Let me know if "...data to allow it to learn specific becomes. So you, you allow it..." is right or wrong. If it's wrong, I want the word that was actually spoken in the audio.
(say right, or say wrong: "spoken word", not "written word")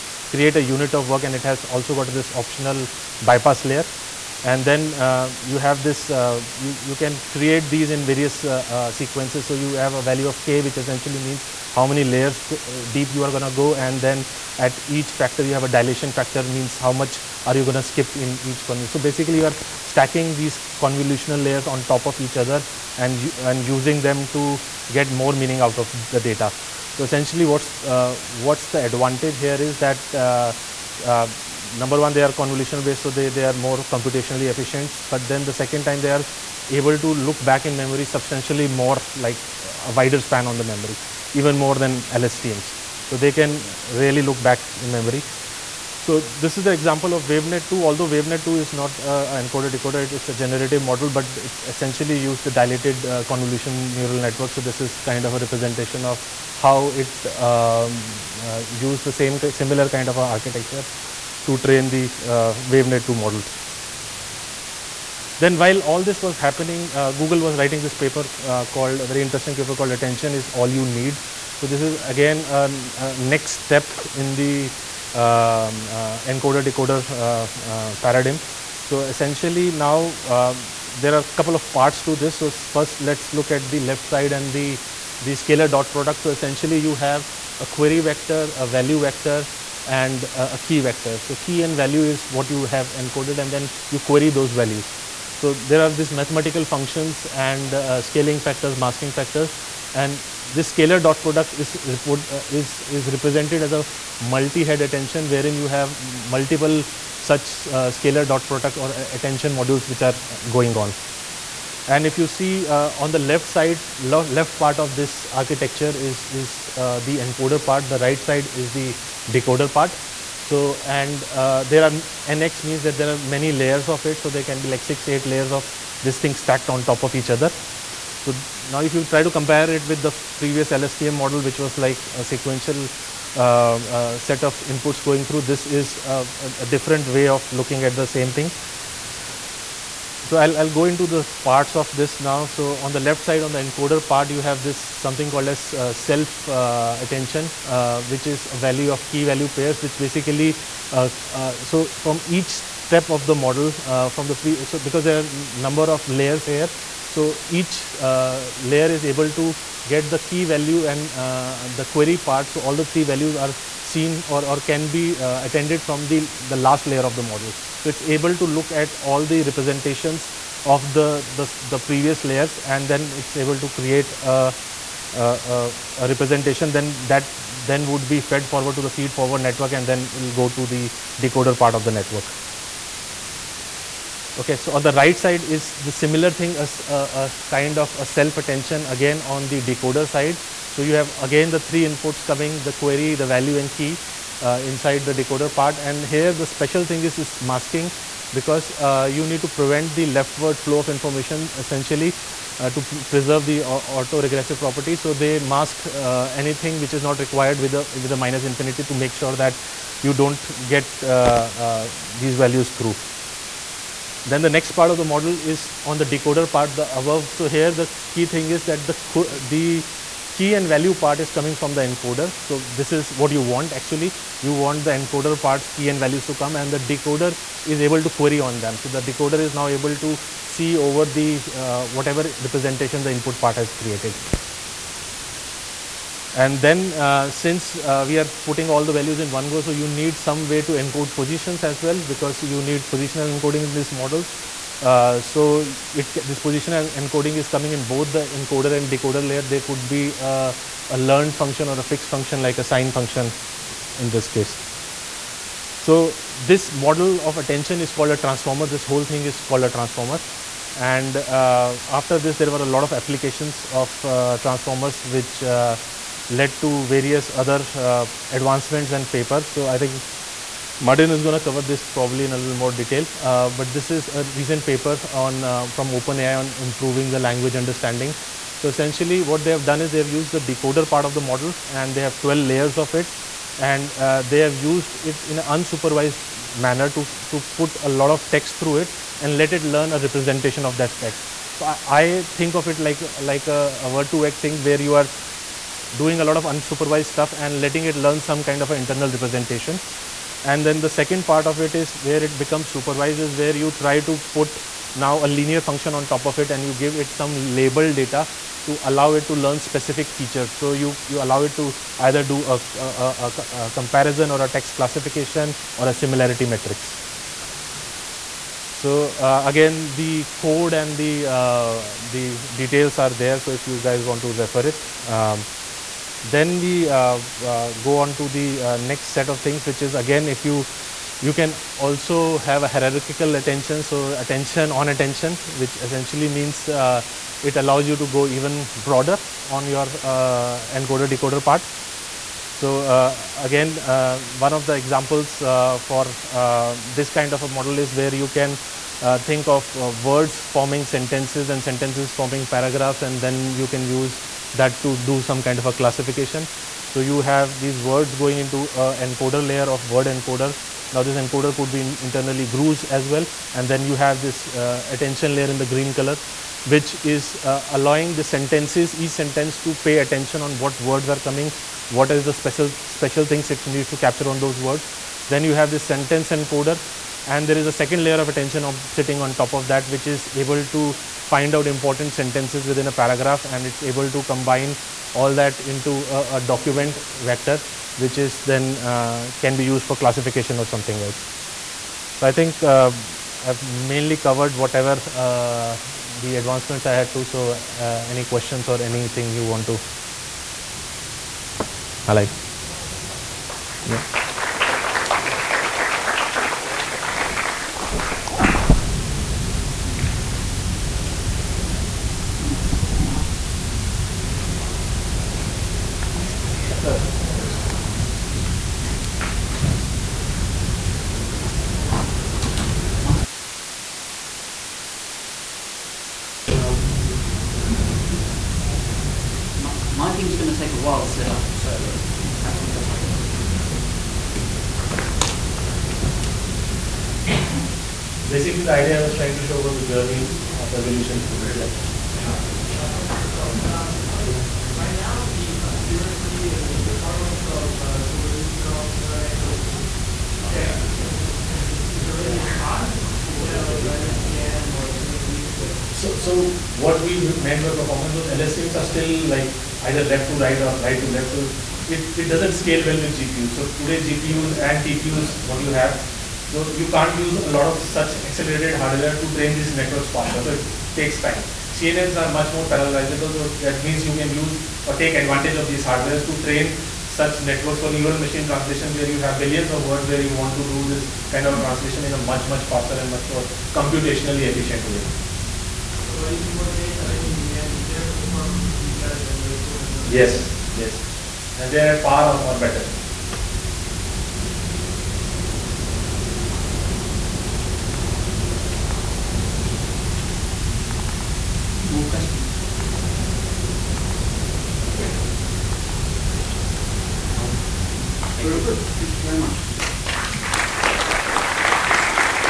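wrong: "features", not "becomes".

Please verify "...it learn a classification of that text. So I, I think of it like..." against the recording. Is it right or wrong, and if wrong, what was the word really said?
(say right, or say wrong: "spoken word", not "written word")
wrong: "representation", not "classification".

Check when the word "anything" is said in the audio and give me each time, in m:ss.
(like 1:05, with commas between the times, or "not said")
3:26, 6:38.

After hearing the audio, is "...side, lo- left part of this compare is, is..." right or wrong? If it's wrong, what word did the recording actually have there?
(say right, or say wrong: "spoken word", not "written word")
wrong: "architecture", not "compare".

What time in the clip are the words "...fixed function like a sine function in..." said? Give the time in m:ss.
4:11.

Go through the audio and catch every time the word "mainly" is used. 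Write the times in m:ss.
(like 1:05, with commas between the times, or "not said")
6:33.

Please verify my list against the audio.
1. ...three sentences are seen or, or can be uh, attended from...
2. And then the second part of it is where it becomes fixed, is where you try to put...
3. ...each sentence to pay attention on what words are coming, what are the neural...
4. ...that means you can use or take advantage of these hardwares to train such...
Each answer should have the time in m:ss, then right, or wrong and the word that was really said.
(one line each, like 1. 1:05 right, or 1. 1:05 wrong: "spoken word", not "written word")
1. 2:42 wrong: "values", not "sentences"
2. 5:00 wrong: "supervised", not "fixed"
3. 6:08 wrong: "special", not "neural"
4. 7:53 right.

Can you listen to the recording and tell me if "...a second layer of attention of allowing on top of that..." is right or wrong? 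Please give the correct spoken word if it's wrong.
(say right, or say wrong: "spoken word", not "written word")
wrong: "sitting", not "allowing".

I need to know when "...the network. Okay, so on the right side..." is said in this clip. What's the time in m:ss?
3:01.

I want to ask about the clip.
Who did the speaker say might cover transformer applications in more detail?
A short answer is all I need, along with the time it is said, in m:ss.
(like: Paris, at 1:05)
Martin, at 4:30.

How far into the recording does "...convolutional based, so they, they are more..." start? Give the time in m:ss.
0:32.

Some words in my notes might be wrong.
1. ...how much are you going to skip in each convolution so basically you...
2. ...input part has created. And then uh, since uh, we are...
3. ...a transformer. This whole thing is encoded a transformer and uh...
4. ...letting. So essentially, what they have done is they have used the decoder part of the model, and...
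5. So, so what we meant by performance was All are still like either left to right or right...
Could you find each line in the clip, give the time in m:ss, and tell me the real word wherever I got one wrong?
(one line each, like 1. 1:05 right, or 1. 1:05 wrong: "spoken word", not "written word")
1. 0:16 right
2. 3:53 right
3. 4:18 wrong: "called", not "encoded"
4. 4:37 wrong: "understanding", not "letting"
5. 7:35 wrong: "LSTMs", not "All".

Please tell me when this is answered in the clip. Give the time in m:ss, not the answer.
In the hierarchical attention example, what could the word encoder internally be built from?
6:02.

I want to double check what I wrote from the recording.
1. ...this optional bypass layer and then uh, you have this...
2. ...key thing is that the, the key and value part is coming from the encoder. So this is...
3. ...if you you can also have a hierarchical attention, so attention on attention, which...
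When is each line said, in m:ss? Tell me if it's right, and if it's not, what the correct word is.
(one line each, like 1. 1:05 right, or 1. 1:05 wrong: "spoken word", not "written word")
1. 0:02 right
2. 3:38 right
3. 5:30 right.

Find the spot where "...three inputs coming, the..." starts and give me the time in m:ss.
3:11.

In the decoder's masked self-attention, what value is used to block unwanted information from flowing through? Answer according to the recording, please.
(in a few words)
minus infinity.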